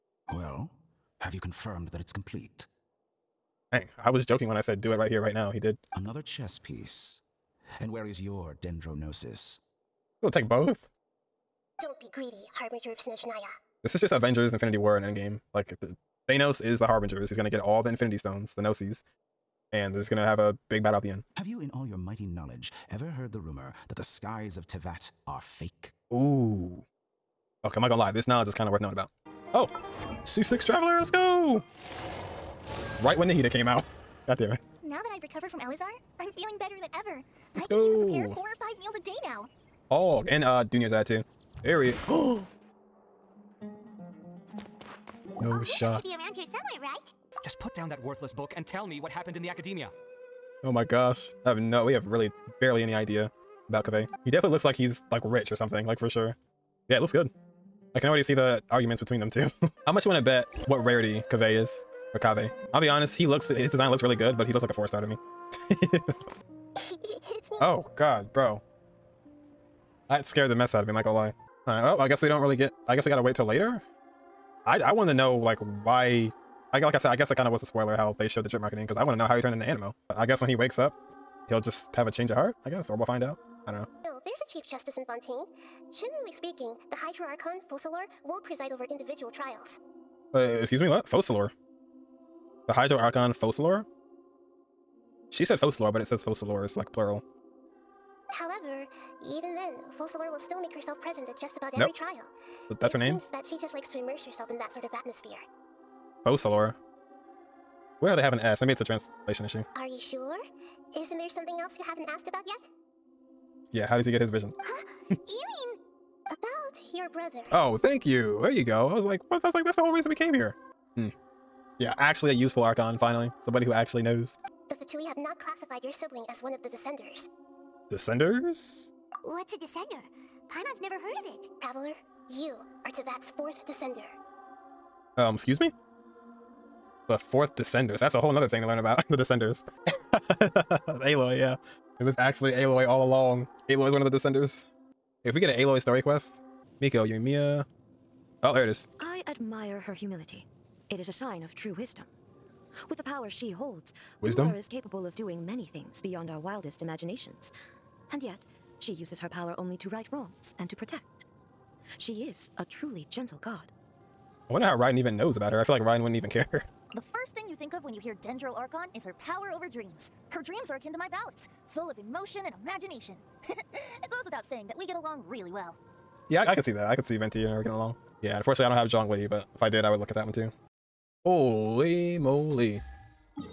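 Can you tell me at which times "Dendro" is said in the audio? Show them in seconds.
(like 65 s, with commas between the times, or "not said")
8 s, 168 s.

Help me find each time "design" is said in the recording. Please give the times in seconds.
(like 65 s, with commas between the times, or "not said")
63 s.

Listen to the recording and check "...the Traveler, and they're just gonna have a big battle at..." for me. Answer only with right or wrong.
wrong.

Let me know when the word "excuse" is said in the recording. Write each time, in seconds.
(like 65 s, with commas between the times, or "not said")
90 s, 135 s.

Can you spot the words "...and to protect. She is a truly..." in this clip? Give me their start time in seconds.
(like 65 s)
160 s.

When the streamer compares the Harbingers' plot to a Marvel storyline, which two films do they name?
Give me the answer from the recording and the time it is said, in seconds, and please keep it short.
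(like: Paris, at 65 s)
Infinity War and Endgame, at 14 s.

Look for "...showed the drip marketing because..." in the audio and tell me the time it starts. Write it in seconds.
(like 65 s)
78 s.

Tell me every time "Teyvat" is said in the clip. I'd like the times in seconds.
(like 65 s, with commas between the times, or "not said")
24 s, 132 s.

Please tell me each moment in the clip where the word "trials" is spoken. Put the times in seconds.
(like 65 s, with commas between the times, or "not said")
89 s, 101 s.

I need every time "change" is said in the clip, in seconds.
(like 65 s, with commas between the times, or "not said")
82 s.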